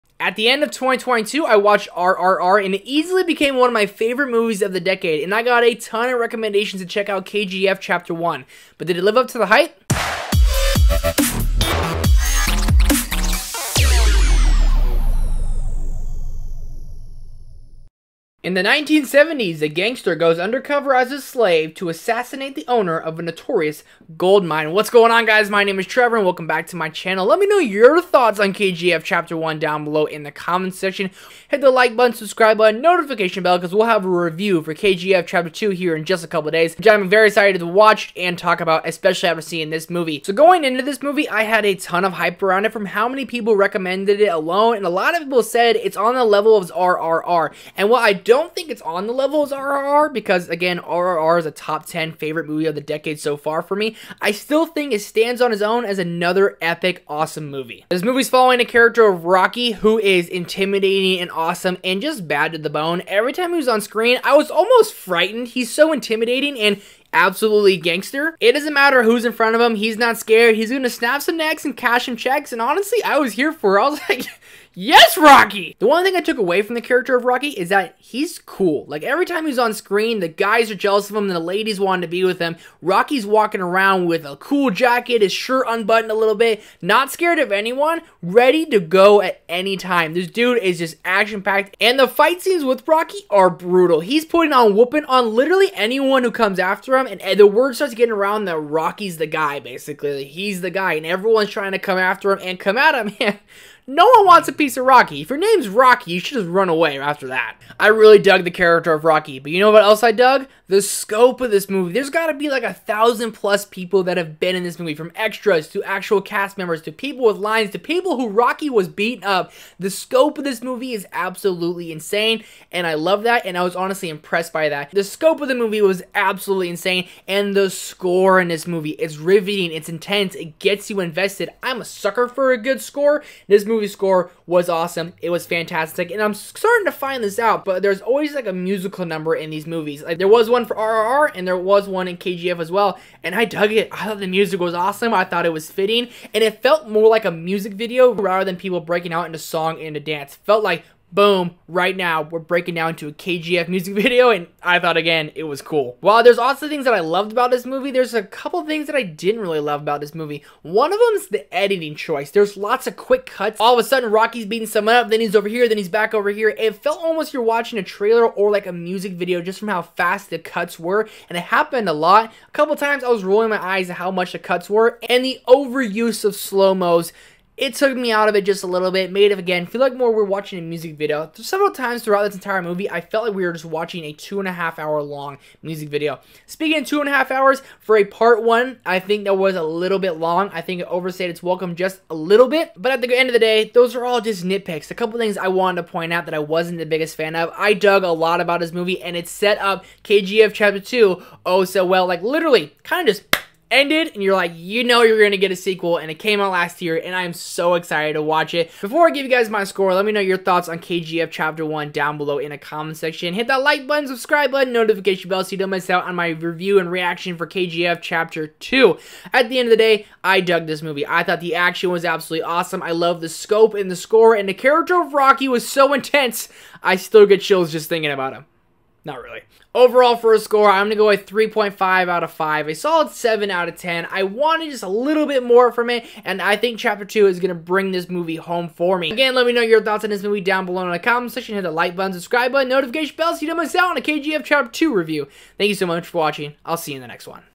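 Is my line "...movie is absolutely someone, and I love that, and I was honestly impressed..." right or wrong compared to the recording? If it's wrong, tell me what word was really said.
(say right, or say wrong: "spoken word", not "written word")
wrong: "insane", not "someone".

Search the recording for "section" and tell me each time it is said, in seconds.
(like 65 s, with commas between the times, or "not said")
30 s, 212 s, 241 s.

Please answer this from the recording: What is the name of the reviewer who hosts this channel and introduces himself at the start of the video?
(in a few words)
Trevor.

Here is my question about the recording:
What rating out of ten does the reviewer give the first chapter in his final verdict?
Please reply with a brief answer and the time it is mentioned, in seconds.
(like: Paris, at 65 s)
7 out of 10, at 233 s.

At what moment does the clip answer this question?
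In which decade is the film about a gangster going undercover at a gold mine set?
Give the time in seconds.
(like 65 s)
18 s.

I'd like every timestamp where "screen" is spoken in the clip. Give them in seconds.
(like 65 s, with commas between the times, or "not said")
63 s, 79 s.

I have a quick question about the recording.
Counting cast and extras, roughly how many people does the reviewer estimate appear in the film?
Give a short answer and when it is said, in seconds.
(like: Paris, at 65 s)
A thousand plus, at 112 s.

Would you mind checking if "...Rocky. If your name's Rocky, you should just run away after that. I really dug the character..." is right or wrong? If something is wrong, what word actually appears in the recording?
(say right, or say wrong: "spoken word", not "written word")
right.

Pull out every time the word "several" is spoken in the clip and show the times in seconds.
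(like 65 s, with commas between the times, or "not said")
181 s.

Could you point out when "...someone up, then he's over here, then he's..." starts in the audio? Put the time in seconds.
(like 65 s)
164 s.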